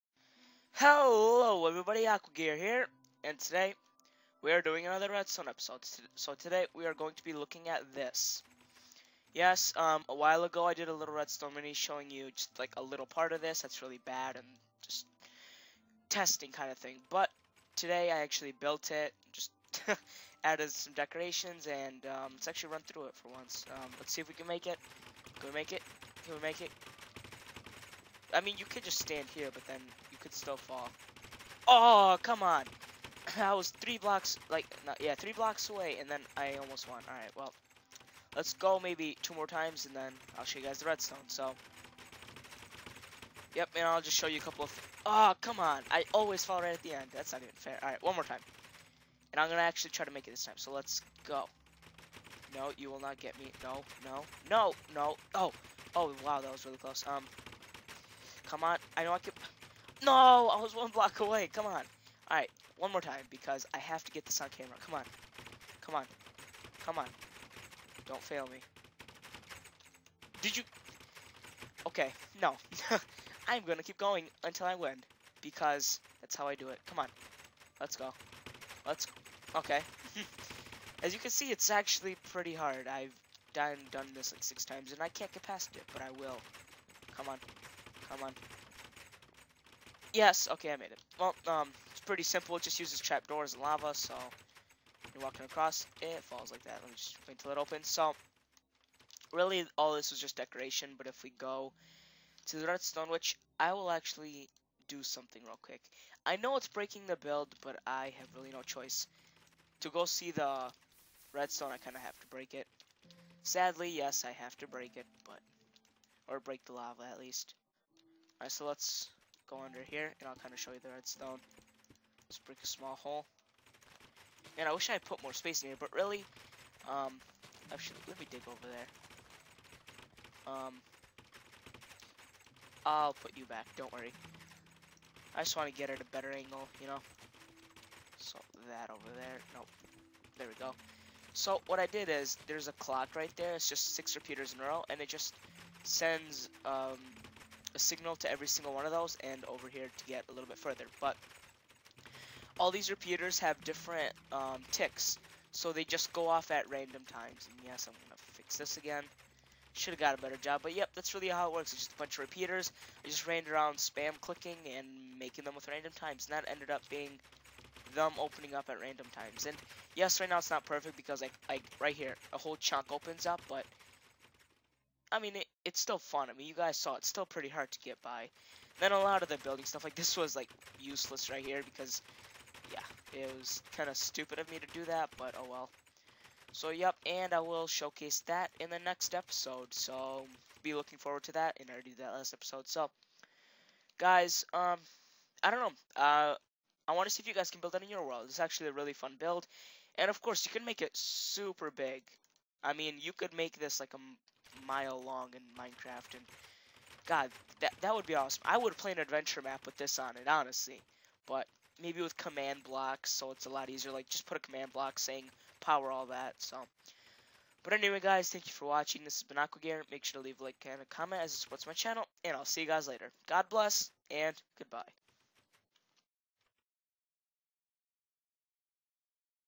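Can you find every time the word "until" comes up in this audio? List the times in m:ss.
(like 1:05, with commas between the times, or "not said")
1:14, 1:37.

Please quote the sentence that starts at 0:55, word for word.
Oh, oh, wow, that was really close.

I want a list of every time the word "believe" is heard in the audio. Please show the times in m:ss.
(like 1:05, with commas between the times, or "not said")
not said.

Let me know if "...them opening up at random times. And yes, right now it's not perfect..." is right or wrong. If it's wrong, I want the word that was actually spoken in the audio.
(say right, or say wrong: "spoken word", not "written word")
right.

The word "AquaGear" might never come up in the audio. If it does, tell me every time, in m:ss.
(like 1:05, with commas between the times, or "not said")
0:02, 3:39.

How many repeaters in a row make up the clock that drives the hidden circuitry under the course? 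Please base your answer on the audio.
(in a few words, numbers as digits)
6.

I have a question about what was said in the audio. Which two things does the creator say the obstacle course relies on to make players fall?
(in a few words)
Trapdoors and lava.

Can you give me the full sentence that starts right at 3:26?
And God, that, that would be awesome.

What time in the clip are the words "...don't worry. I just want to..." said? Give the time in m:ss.
2:13.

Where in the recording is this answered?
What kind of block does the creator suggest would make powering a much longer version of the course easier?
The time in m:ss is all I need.
3:32.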